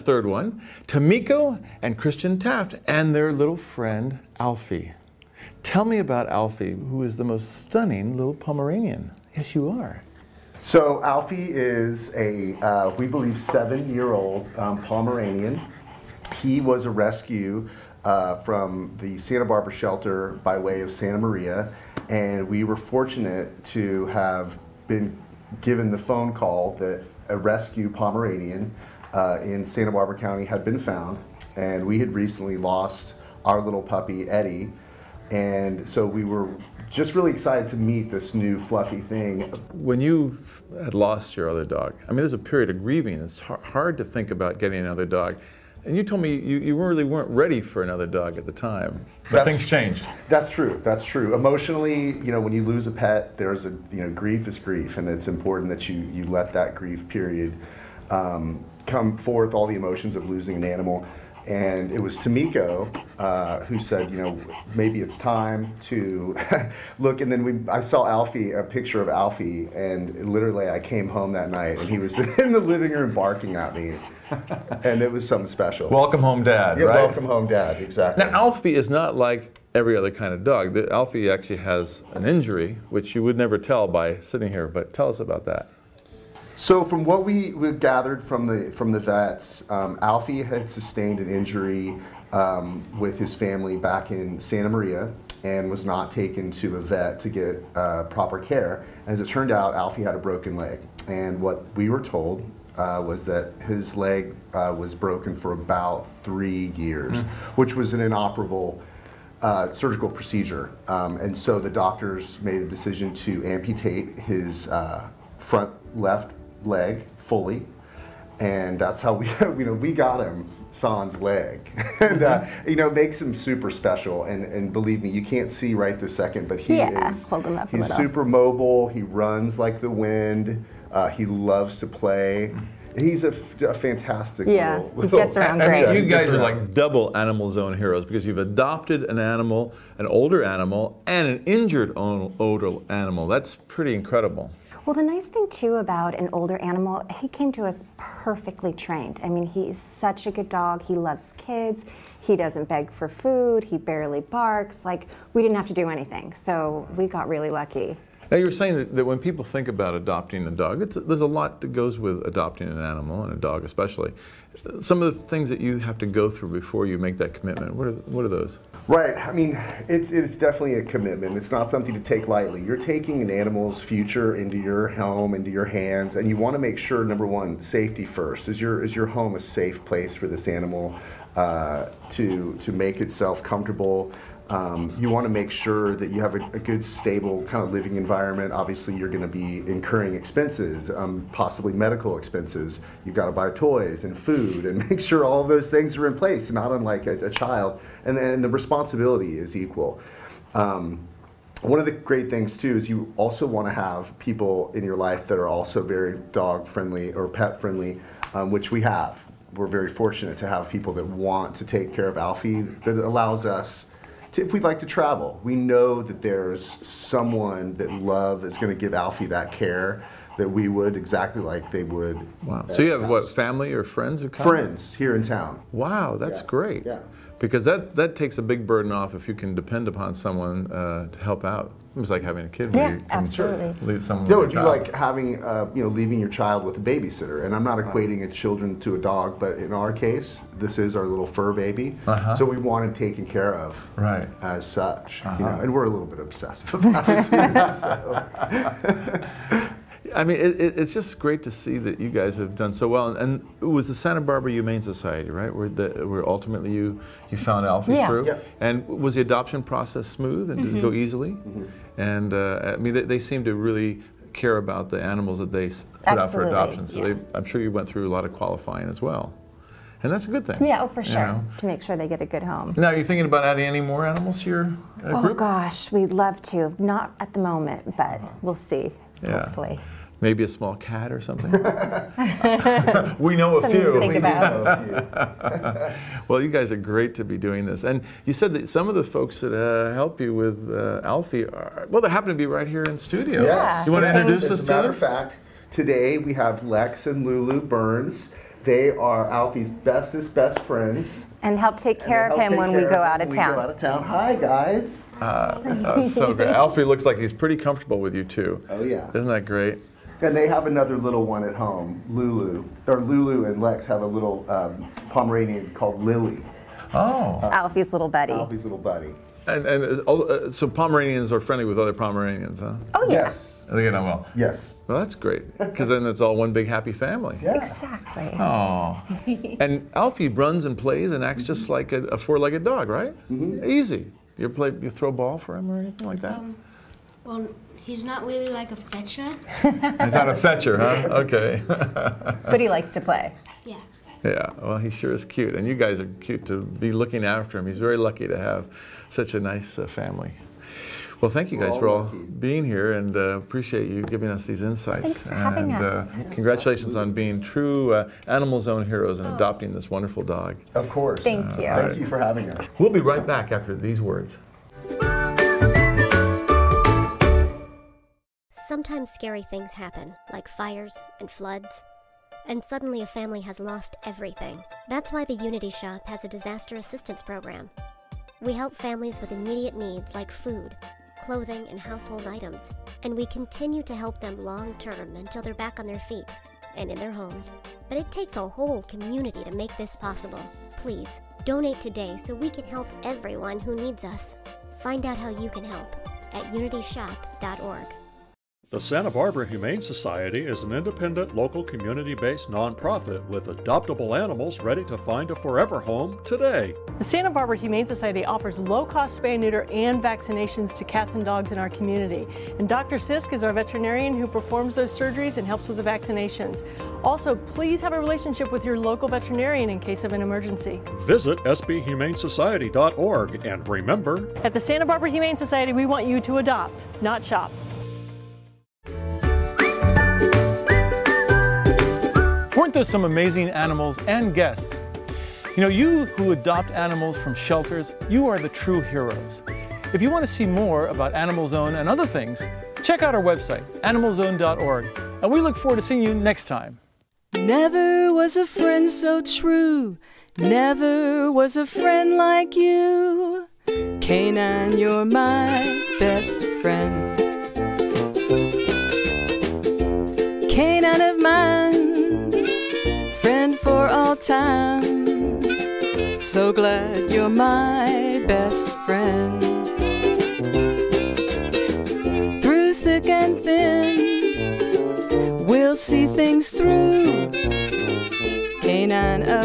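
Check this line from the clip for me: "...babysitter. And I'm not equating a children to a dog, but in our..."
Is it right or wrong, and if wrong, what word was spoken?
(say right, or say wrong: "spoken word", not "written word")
right.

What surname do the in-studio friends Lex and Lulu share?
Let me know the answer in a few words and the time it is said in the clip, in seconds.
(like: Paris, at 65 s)
Burns, at 297 s.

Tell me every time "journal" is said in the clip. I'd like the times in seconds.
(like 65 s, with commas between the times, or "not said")
not said.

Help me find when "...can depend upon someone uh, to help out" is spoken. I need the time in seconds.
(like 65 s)
229 s.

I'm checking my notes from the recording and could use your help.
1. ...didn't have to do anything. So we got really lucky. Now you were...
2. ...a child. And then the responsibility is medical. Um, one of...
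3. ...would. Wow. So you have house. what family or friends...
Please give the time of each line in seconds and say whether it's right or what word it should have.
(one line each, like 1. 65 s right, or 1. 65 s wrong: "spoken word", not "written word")
1. 155 s right
2. 197 s wrong: "equal", not "medical"
3. 221 s right.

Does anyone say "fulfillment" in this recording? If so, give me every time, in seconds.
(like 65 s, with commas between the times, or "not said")
not said.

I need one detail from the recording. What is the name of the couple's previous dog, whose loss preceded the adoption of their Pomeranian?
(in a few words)
Eddie.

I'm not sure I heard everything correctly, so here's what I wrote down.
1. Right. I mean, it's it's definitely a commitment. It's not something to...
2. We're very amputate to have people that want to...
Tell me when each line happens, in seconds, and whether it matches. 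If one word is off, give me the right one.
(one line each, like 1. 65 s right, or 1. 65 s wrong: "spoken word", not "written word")
1. 168 s right
2. 209 s wrong: "fortunate", not "amputate".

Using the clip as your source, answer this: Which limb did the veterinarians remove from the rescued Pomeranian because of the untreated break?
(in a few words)
front left leg.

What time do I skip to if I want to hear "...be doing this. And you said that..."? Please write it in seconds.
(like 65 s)
287 s.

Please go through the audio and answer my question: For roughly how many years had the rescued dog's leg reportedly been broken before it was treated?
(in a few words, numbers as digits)
3.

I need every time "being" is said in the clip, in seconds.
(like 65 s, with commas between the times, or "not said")
352 s, 357 s.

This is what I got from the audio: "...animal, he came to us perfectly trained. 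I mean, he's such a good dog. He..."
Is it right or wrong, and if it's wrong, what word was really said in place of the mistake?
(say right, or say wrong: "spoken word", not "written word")
right.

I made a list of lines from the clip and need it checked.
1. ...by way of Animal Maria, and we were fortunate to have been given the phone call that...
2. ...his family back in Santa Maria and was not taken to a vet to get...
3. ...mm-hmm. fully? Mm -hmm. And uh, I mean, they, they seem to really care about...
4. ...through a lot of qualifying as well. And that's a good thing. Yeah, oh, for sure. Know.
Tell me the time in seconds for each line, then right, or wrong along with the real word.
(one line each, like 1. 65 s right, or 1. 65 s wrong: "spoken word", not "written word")
1. 20 s wrong: "Santa", not "Animal"
2. 93 s right
3. 260 s wrong: "easily", not "fully"
4. 267 s right.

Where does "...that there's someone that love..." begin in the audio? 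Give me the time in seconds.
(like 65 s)
216 s.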